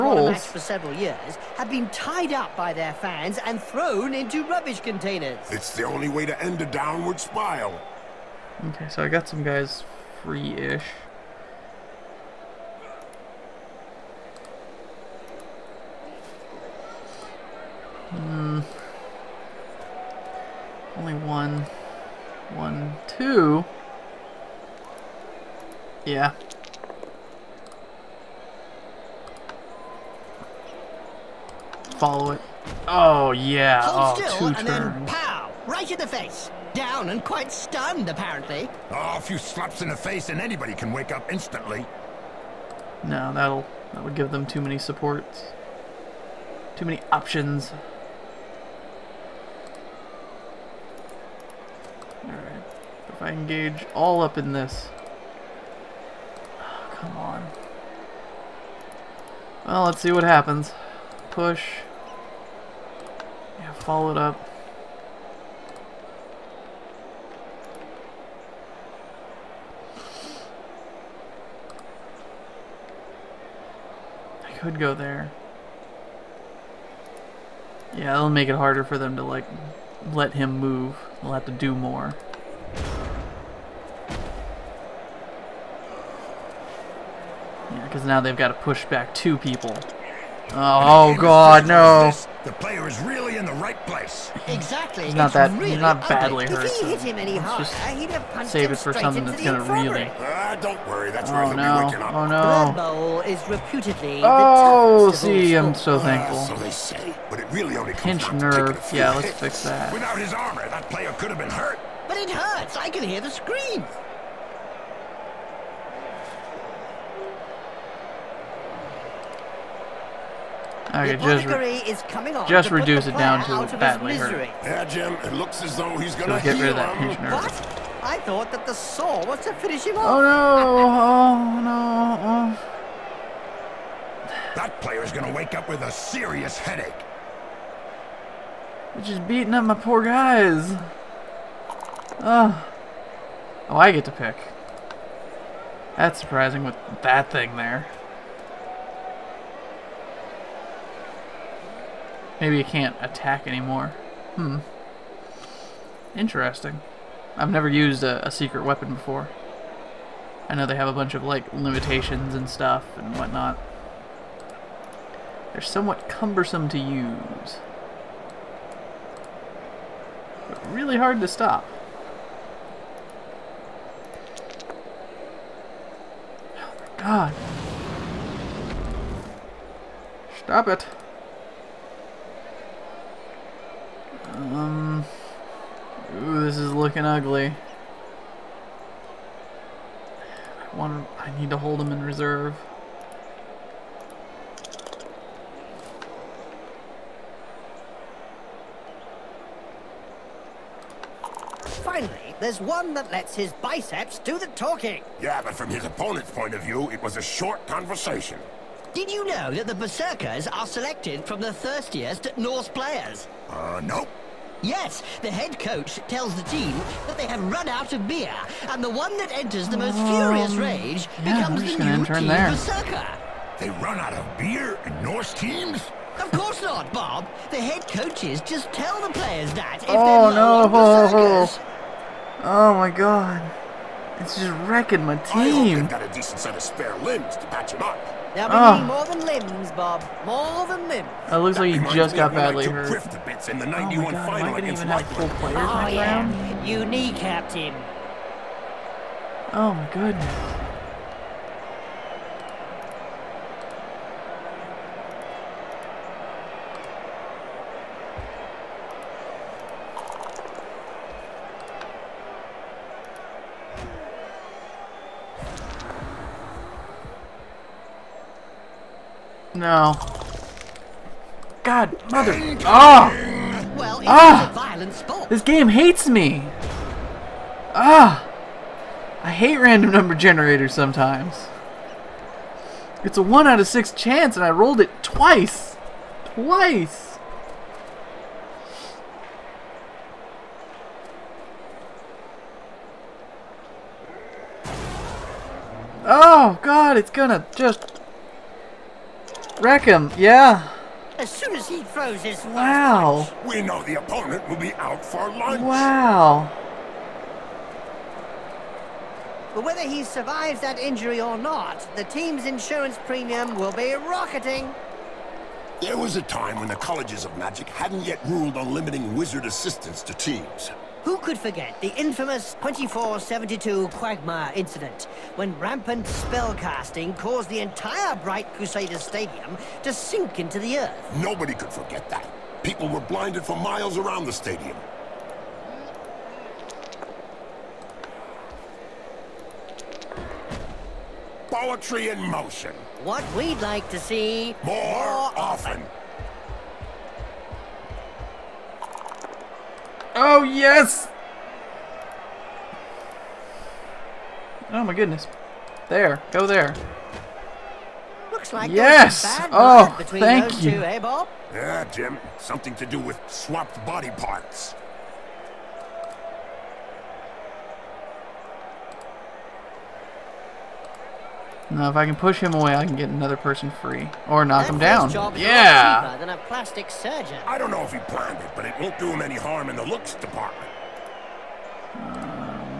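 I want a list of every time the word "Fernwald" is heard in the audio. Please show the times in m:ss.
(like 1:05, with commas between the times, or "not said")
not said.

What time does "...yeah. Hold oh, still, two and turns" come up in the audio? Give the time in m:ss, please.
0:33.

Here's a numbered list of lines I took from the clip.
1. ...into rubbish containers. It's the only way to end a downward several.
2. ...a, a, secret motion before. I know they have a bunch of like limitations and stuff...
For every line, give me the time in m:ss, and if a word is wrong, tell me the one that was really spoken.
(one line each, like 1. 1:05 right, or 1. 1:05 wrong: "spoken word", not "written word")
1. 0:04 wrong: "spiral", not "several"
2. 2:38 wrong: "weapon", not "motion".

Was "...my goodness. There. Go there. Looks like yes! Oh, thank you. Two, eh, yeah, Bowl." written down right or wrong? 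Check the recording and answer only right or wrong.
wrong.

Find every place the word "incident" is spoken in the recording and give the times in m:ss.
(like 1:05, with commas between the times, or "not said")
5:24.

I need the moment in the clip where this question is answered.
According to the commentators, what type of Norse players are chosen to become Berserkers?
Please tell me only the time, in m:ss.
3:31.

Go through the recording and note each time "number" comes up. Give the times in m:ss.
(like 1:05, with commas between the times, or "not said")
4:39.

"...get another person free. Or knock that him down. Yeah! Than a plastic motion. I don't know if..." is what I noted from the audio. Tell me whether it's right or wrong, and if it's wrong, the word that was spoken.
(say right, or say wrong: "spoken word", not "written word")
wrong: "surgeon", not "motion".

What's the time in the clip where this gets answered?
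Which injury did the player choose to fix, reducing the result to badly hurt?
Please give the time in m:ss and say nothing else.
1:47.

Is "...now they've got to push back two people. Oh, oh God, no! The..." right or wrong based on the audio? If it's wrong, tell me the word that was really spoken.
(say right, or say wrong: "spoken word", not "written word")
right.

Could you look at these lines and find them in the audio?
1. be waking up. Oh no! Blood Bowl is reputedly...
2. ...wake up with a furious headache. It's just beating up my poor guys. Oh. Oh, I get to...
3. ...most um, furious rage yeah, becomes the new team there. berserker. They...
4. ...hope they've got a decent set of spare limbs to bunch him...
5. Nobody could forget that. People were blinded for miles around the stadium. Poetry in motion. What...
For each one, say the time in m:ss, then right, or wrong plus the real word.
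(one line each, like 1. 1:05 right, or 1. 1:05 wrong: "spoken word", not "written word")
1. 1:41 right
2. 2:15 wrong: "serious", not "furious"
3. 3:39 right
4. 3:55 wrong: "patch", not "bunch"
5. 5:31 right.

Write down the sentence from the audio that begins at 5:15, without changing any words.
There was a time when the colleges of magic hadn't yet ruled on limiting wizard assistance to teams.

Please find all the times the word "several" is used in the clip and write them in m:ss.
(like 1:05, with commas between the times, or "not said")
0:00.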